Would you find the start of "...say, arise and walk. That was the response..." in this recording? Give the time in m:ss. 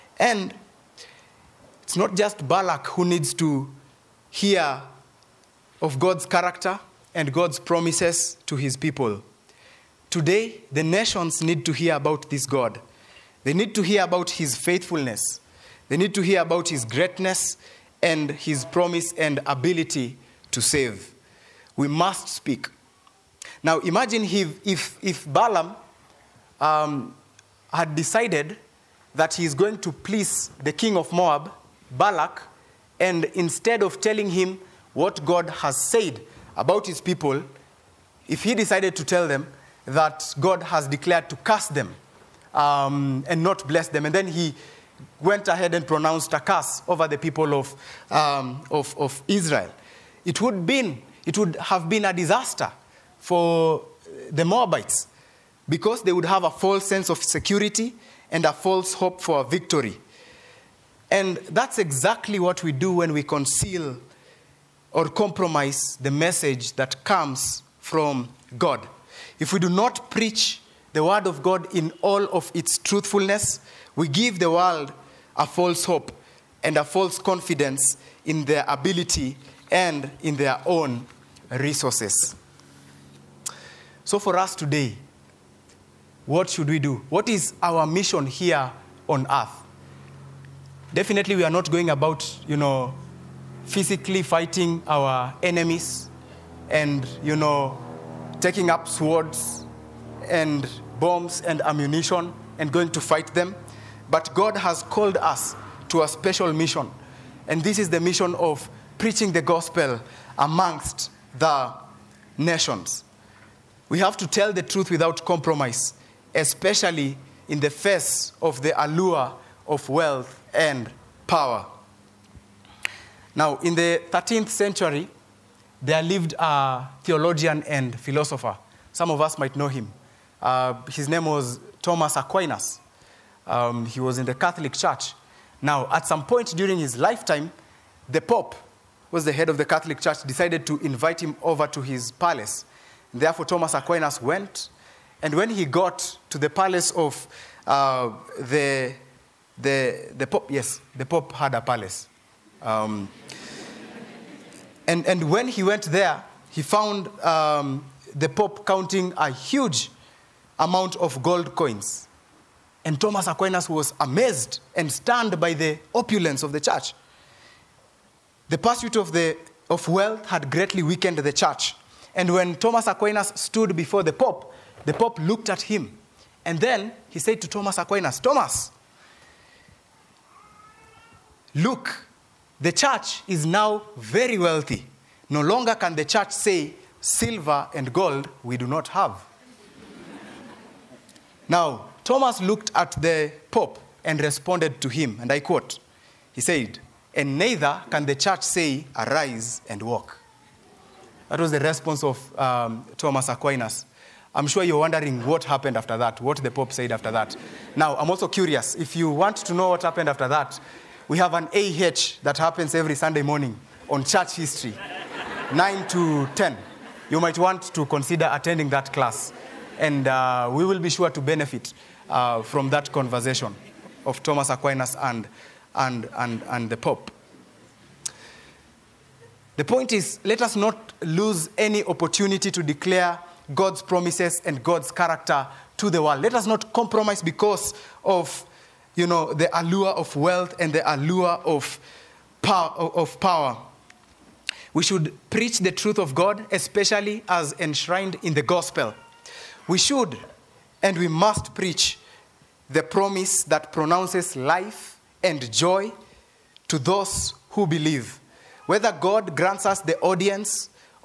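3:18.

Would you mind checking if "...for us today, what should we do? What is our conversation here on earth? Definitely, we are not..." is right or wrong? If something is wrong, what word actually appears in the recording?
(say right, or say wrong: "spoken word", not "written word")
wrong: "mission", not "conversation".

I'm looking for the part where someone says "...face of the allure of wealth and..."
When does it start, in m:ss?
1:57.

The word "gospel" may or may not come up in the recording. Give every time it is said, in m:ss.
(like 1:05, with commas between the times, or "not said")
1:49, 4:08.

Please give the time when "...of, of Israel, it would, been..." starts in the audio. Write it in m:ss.
0:48.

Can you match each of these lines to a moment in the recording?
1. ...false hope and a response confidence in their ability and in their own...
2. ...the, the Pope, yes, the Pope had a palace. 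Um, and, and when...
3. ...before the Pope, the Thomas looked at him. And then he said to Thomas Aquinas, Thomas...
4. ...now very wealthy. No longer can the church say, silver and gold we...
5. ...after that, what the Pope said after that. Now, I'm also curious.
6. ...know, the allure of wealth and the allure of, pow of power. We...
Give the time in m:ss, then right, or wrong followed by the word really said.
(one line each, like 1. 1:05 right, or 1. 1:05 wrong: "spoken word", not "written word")
1. 1:15 wrong: "false", not "response"
2. 2:29 right
3. 2:53 wrong: "Pope", not "Thomas"
4. 3:03 right
5. 3:25 right
6. 3:59 right.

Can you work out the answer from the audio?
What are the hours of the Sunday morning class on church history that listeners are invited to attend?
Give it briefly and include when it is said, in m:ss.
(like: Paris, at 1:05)
9 to 10, at 3:35.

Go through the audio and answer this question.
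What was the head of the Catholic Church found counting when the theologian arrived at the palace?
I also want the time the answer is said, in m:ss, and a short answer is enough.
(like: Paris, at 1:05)
Gold coins, at 2:41.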